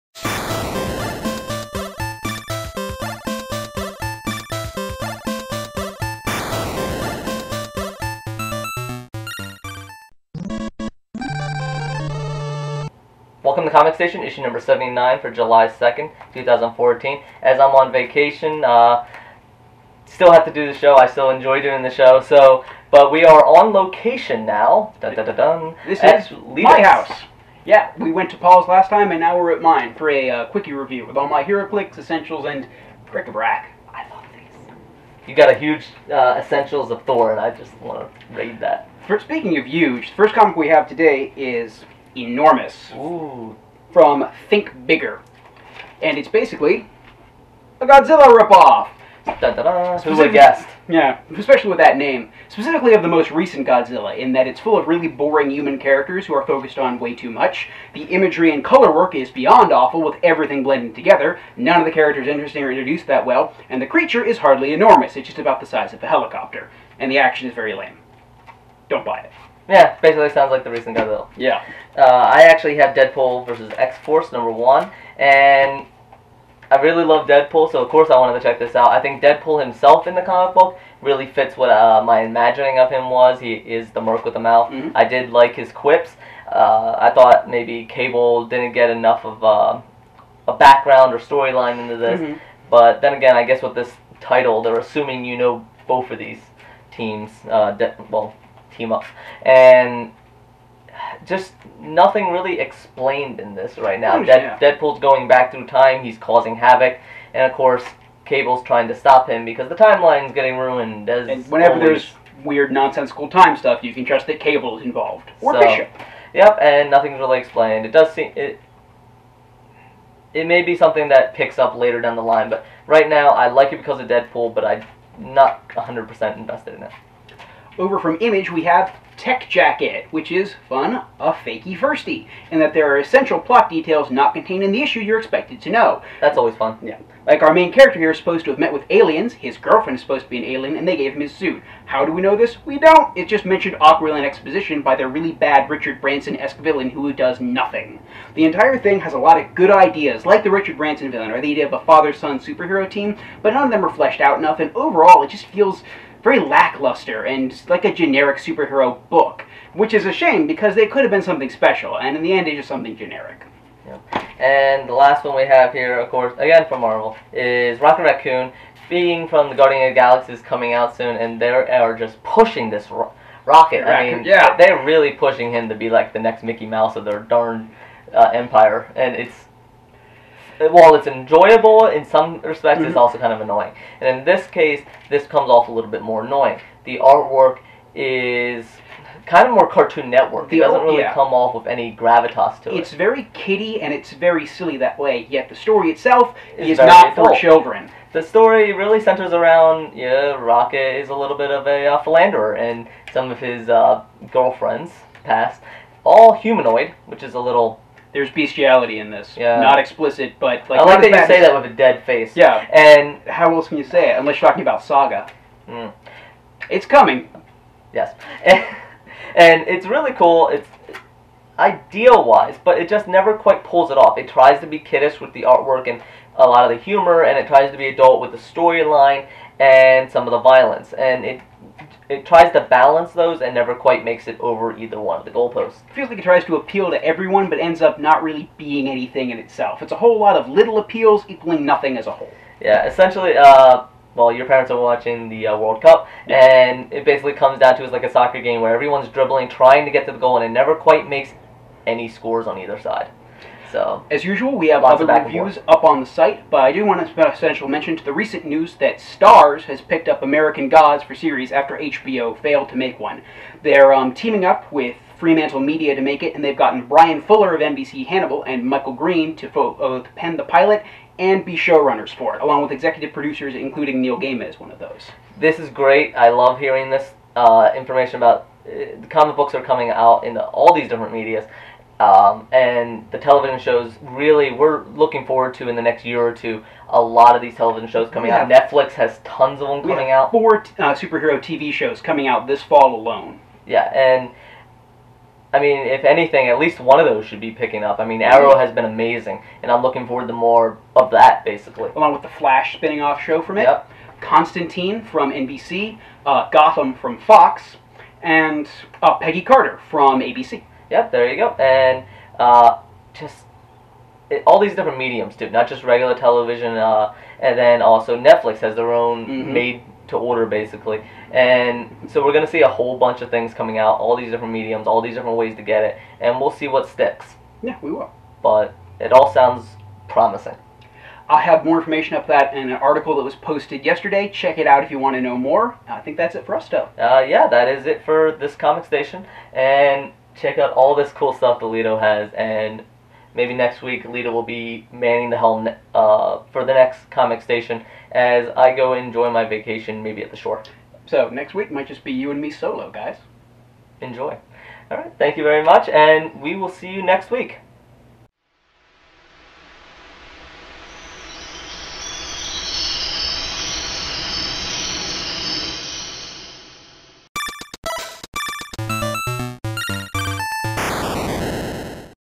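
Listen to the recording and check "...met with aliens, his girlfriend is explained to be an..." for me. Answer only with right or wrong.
wrong.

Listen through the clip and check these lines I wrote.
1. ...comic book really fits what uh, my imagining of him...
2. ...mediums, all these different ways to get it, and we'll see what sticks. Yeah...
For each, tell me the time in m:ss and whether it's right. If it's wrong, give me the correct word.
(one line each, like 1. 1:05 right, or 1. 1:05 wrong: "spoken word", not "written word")
1. 1:20 right
2. 5:24 right.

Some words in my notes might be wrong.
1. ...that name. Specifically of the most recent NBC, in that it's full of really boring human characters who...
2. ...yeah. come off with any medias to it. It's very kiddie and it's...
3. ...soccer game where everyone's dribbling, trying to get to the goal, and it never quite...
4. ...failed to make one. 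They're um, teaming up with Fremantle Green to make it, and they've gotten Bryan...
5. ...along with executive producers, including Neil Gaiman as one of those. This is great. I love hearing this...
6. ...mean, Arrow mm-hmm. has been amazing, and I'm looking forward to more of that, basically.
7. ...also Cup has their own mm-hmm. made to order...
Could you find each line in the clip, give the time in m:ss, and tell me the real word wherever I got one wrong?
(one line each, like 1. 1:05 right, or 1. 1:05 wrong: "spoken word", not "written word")
1. 0:51 wrong: "Godzilla", not "NBC"
2. 3:10 wrong: "gravitas", not "medias"
3. 4:08 right
4. 4:22 wrong: "Media", not "Green"
5. 4:32 right
6. 4:58 right
7. 5:17 wrong: "Netflix", not "Cup".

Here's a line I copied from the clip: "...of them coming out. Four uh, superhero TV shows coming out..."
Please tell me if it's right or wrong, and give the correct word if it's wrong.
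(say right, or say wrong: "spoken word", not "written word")
right.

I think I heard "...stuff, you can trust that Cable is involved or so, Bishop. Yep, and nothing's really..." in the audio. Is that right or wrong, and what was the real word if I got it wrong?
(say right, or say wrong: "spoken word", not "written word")
right.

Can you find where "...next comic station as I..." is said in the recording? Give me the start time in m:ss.
5:46.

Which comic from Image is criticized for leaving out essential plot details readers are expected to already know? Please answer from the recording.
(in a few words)
Tech Jacket.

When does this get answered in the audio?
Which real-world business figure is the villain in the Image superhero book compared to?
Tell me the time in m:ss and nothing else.
2:30.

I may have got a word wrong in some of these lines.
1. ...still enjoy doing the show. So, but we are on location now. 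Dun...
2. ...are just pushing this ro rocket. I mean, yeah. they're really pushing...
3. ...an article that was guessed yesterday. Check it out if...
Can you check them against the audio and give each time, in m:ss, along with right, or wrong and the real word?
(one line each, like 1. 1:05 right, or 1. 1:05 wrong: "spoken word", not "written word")
1. 0:21 right
2. 2:51 right
3. 5:32 wrong: "posted", not "guessed".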